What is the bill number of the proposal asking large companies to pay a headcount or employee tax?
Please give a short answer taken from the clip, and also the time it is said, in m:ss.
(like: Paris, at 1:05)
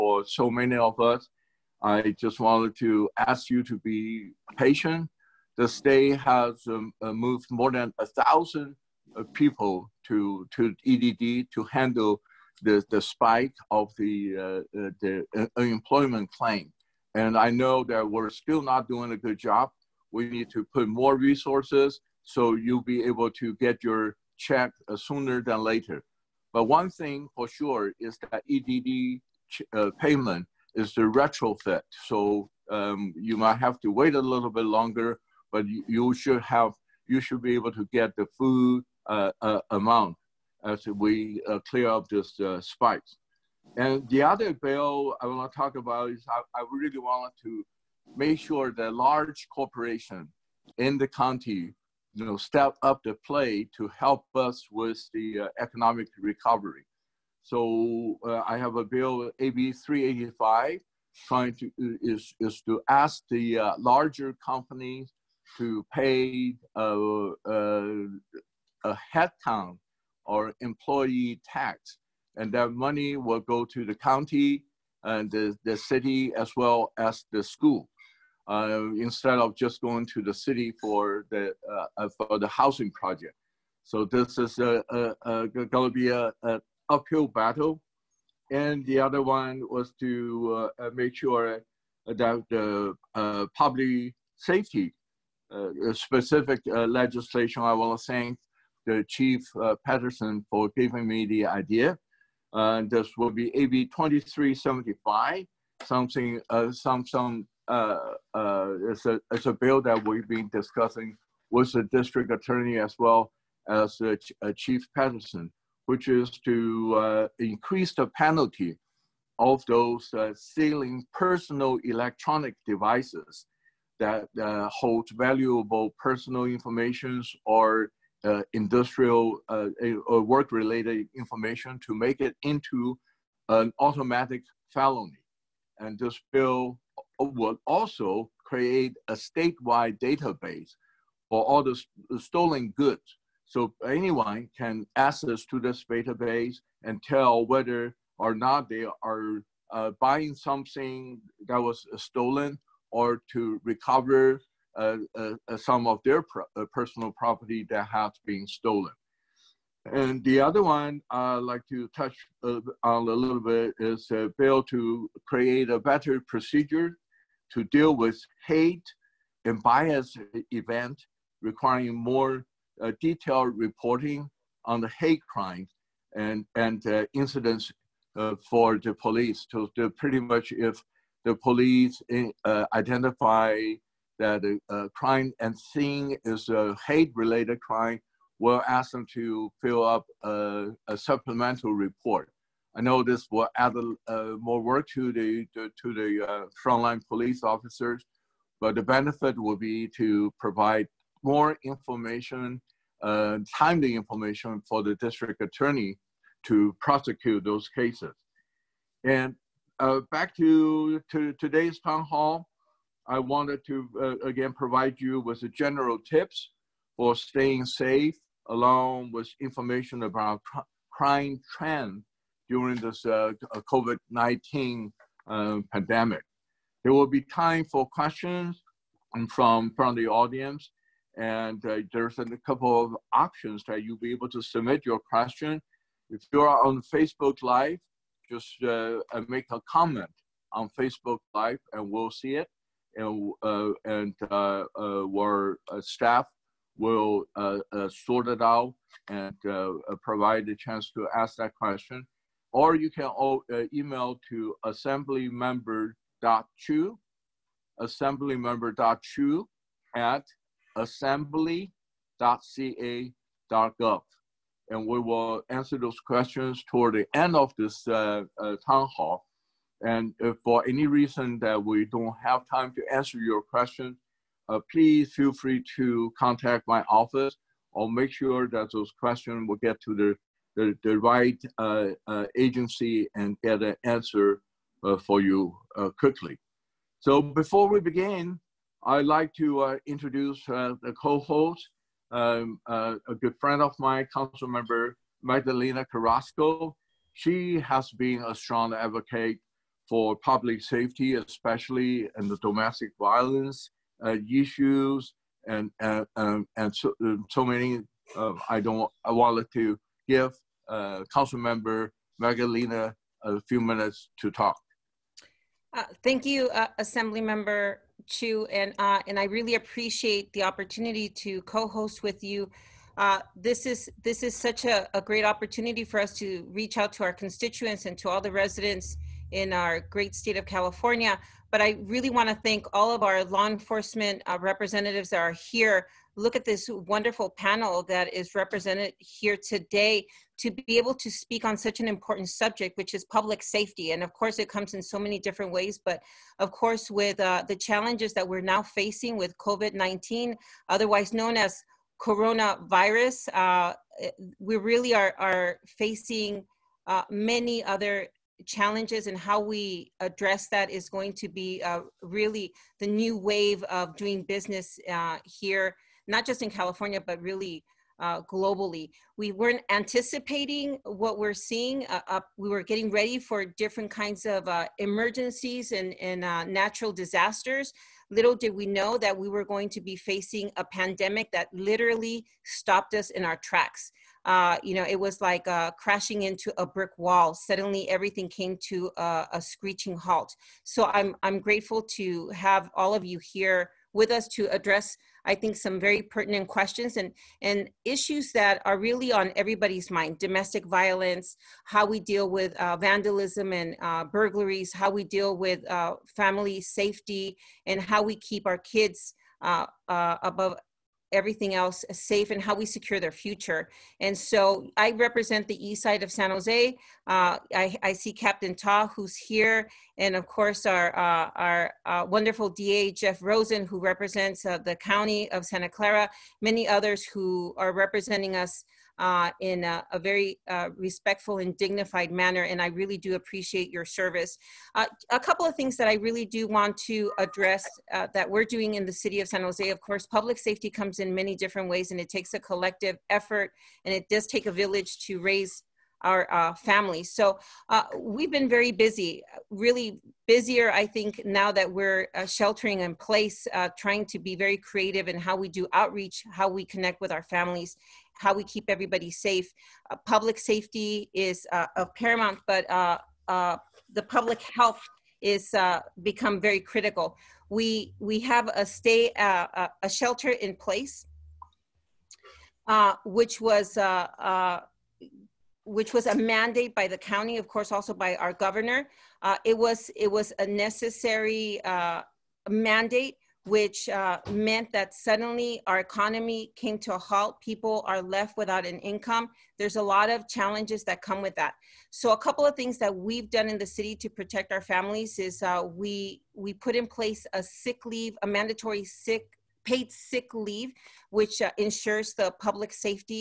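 AB 385, at 0:59.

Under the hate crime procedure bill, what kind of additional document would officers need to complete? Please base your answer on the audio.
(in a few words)
supplemental report.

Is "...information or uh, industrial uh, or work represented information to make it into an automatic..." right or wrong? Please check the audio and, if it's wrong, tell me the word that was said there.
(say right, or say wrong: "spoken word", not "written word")
wrong: "related", not "represented".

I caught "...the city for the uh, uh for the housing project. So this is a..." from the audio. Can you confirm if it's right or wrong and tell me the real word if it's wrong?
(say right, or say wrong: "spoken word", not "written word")
right.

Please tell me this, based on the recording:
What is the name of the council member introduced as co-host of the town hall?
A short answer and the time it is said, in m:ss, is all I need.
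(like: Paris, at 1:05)
Magdalena Carrasco, at 4:55.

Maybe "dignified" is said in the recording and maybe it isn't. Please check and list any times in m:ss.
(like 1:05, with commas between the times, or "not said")
7:11.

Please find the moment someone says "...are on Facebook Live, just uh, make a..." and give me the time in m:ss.
3:56.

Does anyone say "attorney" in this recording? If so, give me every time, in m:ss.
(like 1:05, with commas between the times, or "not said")
1:52, 3:25.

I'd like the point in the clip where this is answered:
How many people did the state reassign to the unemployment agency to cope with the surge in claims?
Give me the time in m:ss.
0:07.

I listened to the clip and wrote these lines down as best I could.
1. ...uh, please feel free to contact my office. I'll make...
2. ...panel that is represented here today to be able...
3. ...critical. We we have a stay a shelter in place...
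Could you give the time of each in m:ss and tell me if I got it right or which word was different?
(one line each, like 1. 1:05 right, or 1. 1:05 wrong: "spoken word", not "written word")
1. 4:34 right
2. 5:37 right
3. 7:46 right.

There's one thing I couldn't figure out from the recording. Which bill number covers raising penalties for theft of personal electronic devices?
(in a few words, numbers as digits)
AB 2375.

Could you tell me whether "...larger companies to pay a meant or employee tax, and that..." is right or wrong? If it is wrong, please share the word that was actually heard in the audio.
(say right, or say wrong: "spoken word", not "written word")
wrong: "headcount", not "meant".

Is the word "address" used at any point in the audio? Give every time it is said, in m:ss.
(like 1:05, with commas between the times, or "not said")
6:00, 6:34, 7:17.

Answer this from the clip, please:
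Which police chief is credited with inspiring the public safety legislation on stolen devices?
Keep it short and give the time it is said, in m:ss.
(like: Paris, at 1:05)
Chief Patterson, at 1:39.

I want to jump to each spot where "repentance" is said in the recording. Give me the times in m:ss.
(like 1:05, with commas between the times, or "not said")
not said.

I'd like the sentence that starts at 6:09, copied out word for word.
We weren't anticipating what we're seeing.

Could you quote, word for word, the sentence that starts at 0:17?
And I know that we're still not doing a good job.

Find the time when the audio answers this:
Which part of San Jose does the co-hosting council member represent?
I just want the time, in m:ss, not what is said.
6:55.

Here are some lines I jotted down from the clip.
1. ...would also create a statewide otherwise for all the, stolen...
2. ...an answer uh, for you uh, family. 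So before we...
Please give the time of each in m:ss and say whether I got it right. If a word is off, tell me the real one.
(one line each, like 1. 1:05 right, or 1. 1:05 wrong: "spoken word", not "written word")
1. 2:17 wrong: "database", not "otherwise"
2. 4:43 wrong: "quickly", not "family".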